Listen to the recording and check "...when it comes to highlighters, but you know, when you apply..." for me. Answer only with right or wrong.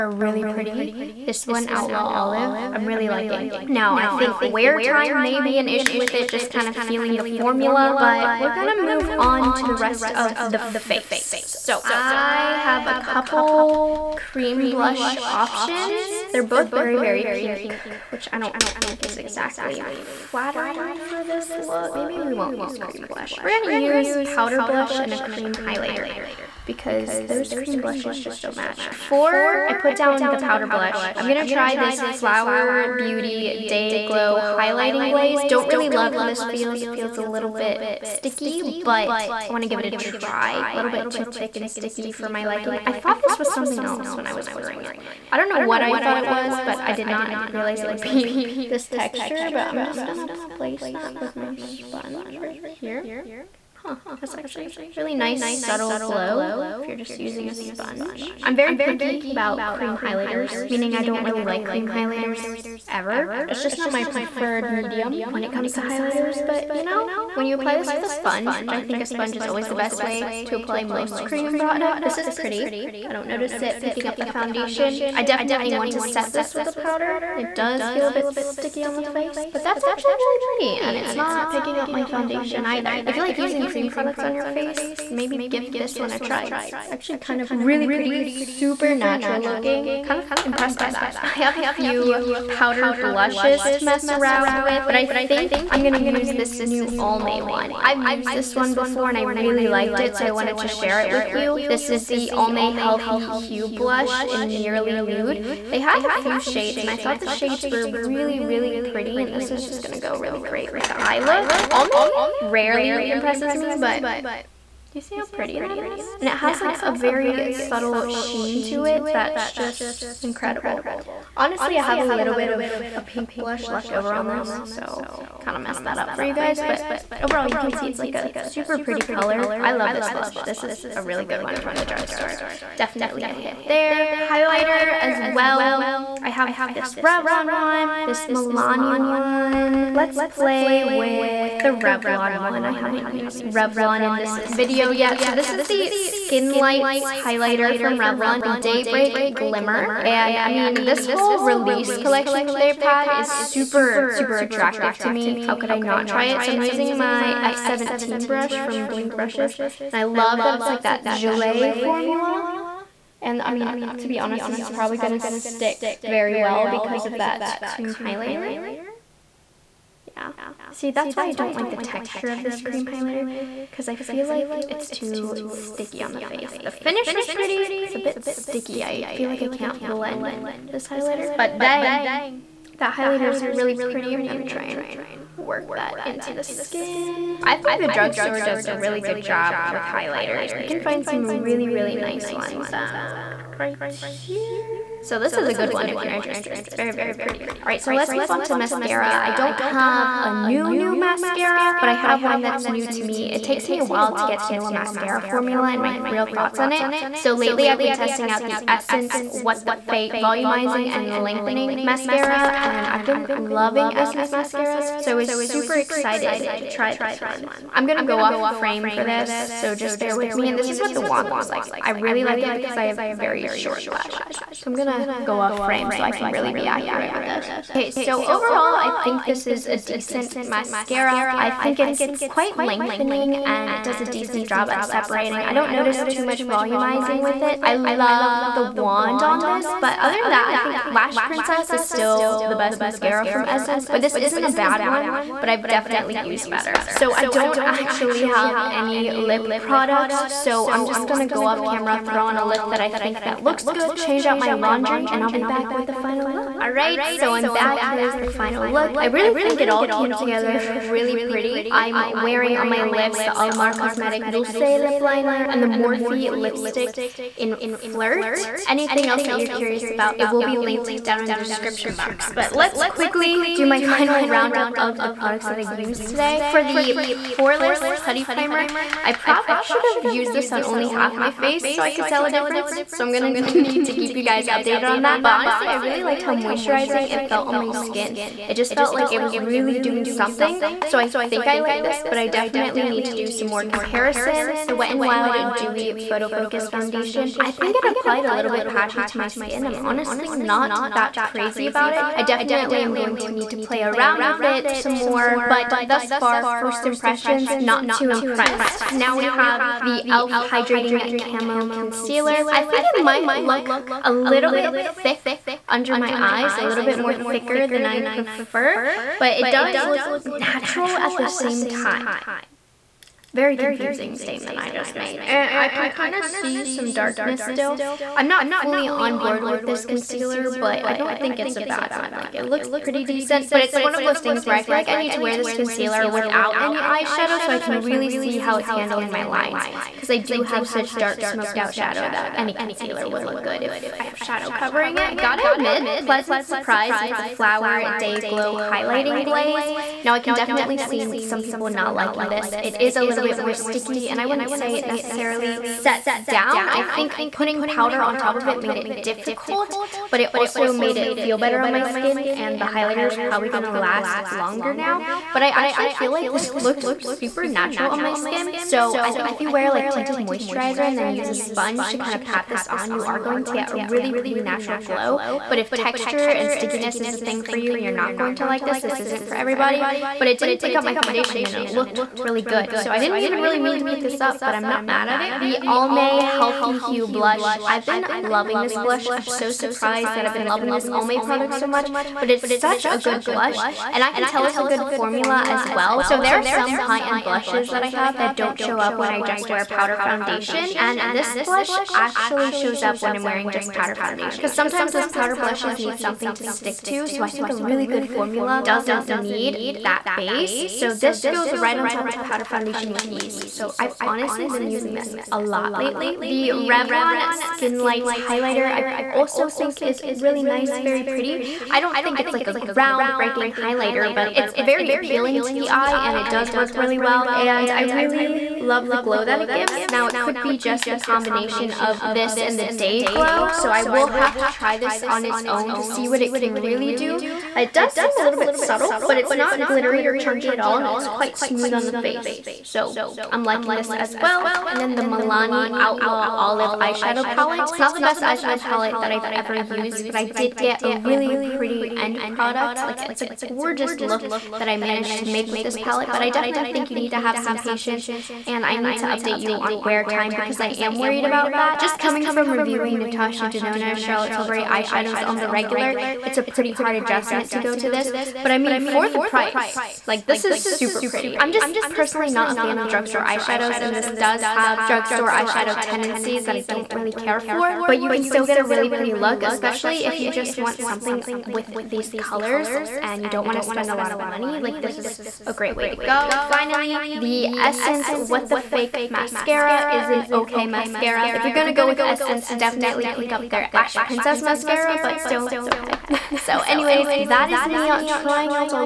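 right.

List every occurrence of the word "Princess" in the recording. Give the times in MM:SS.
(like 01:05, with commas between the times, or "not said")
04:01, 08:14.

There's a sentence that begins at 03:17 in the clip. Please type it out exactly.
All right, so let's move on to mascara.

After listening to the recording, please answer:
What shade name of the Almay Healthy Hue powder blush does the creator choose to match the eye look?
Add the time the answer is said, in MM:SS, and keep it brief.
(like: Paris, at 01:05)
Nearly Nude, at 01:44.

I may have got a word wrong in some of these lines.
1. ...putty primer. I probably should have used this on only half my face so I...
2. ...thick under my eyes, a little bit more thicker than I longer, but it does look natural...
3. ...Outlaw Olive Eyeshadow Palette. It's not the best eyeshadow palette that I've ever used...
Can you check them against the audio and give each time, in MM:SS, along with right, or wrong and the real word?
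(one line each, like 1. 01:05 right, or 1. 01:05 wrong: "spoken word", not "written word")
1. 04:37 right
2. 05:14 wrong: "prefer", not "longer"
3. 07:25 right.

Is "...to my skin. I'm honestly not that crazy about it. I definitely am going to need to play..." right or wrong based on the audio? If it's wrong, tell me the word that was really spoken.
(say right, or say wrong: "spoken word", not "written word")
right.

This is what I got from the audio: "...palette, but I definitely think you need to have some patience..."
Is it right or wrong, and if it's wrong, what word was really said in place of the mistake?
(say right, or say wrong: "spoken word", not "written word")
right.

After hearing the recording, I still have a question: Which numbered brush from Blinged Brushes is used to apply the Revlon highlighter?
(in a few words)
F17.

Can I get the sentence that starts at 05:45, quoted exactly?
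I gotta admit, pleasant surprise with the Flower Day Glow Highlighting Glaze.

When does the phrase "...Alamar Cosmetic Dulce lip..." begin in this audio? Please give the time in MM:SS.
04:23.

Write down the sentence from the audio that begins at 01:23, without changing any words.
If you like using cream products on your face, maybe give this one a try.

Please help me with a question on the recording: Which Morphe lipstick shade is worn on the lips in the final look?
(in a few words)
Flirt.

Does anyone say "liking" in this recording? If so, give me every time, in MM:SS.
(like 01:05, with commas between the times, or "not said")
00:03, 00:42, 05:51, 07:23.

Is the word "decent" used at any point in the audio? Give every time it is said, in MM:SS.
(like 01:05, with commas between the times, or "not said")
03:49, 03:54, 05:33.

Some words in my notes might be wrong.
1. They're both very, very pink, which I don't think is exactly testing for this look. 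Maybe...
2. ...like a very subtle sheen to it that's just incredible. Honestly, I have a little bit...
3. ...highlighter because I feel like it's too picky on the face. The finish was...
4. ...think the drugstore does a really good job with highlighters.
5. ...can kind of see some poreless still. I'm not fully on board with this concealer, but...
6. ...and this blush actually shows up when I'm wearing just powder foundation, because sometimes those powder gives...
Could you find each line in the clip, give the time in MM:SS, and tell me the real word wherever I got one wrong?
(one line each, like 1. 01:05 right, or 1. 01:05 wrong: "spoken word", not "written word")
1. 00:16 wrong: "flattering", not "testing"
2. 01:56 right
3. 02:52 wrong: "sticky", not "picky"
4. 03:07 right
5. 05:25 wrong: "darkness", not "poreless"
6. 06:40 wrong: "blushes", not "gives".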